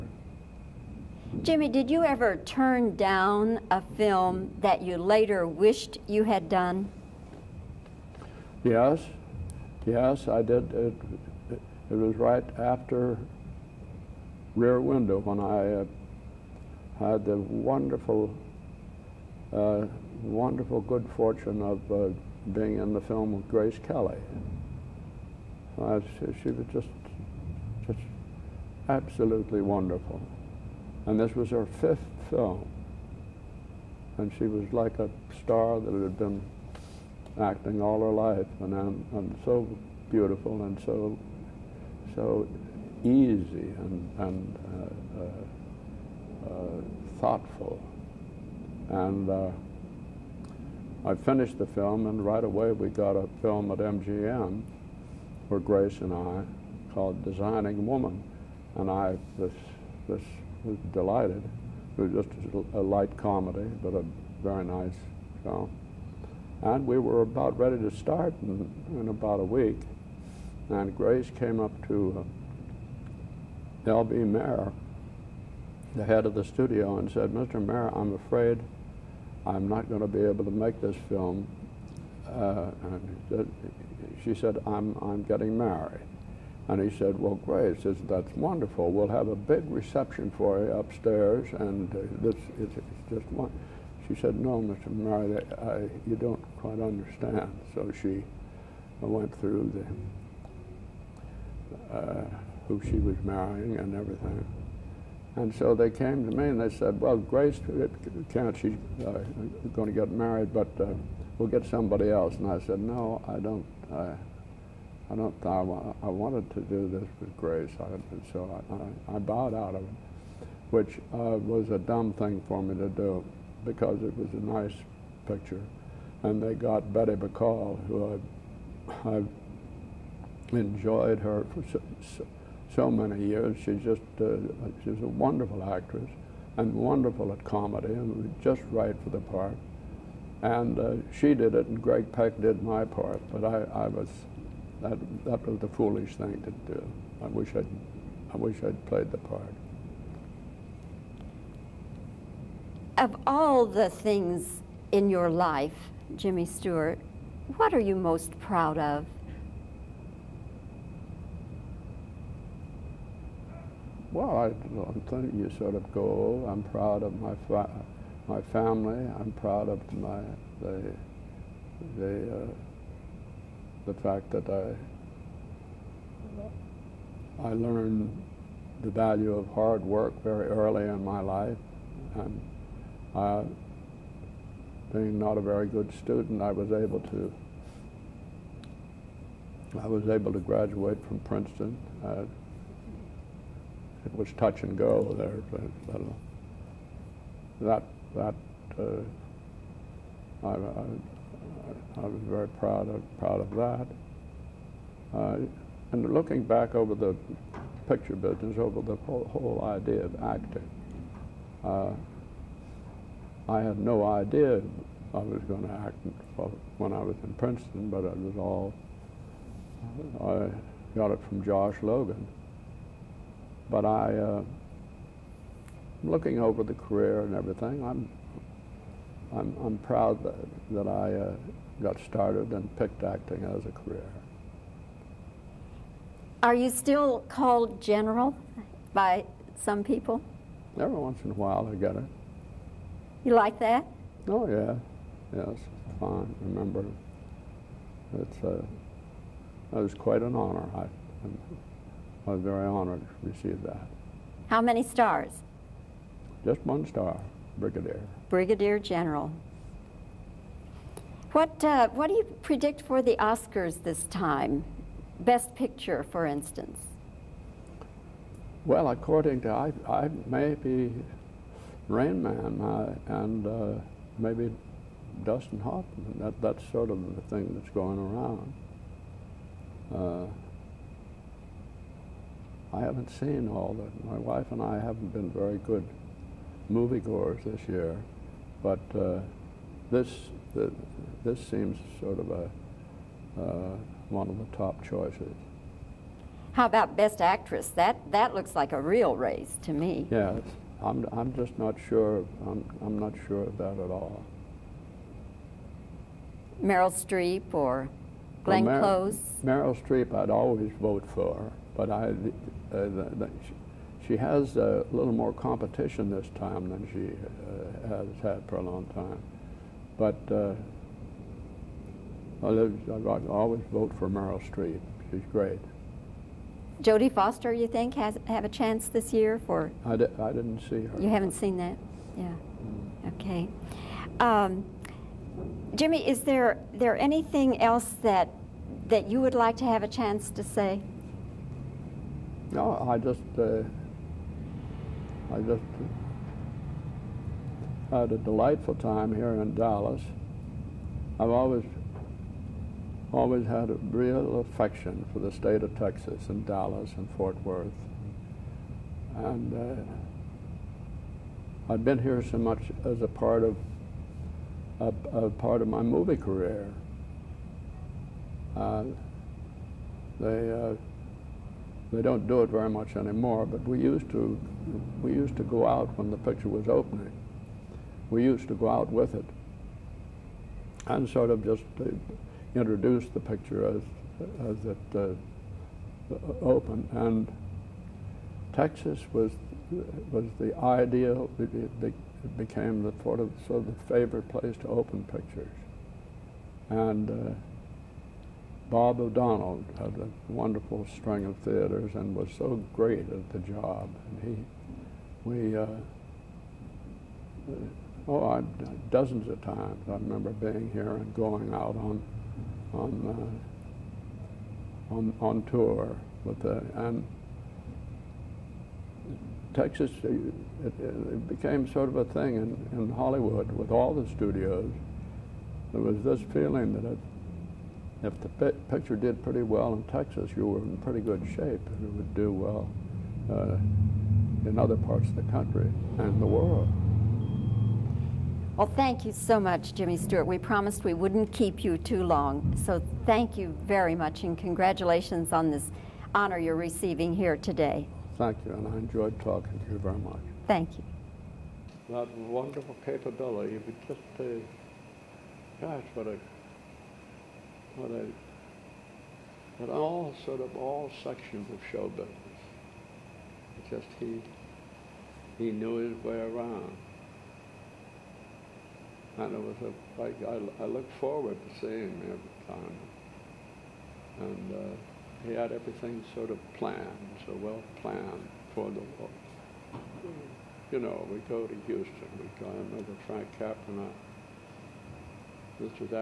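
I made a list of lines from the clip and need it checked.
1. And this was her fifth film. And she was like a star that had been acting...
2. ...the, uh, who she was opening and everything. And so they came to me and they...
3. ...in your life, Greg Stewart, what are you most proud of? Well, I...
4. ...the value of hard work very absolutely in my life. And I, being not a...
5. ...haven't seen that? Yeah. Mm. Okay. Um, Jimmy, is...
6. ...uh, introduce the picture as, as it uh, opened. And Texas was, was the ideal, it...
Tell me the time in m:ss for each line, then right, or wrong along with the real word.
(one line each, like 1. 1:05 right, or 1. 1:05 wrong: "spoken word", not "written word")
1. 0:31 right
2. 1:41 wrong: "marrying", not "opening"
3. 2:34 wrong: "Jimmy", not "Greg"
4. 2:58 wrong: "early", not "absolutely"
5. 5:31 right
6. 6:21 right.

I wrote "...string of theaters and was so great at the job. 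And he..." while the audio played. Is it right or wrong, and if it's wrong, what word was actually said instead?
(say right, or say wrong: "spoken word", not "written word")
right.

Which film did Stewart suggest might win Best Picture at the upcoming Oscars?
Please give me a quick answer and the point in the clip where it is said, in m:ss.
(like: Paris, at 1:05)
Rain Man, at 4:31.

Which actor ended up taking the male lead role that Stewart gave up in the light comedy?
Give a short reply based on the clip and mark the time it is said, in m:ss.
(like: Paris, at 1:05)
Greg Peck, at 2:21.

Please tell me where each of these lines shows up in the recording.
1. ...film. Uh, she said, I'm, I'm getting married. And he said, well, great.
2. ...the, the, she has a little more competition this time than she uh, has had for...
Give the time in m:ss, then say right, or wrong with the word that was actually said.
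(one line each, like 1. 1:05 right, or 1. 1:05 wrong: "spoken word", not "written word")
1. 1:21 right
2. 5:12 right.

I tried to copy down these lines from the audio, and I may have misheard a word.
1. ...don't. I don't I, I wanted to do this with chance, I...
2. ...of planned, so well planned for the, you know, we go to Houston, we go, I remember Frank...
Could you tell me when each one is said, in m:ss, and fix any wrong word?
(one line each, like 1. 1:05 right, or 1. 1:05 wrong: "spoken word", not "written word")
1. 1:53 wrong: "grace", not "chance"
2. 7:56 right.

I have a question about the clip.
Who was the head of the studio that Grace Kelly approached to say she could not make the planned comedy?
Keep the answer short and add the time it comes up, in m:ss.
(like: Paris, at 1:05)
L.B. Mayer, at 1:13.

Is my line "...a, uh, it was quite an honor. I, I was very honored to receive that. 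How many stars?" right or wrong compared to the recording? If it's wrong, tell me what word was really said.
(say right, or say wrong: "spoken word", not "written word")
right.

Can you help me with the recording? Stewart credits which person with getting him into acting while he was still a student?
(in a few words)
Josh Logan.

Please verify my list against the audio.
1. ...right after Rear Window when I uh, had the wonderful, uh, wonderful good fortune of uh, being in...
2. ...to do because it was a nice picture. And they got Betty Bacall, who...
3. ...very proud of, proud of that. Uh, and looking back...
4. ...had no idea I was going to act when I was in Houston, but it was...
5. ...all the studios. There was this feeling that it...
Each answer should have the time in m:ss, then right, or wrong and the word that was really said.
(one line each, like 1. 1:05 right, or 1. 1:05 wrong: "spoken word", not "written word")
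1. 0:12 right
2. 2:02 right
3. 3:22 right
4. 3:33 wrong: "Princeton", not "Houston"
5. 7:03 right.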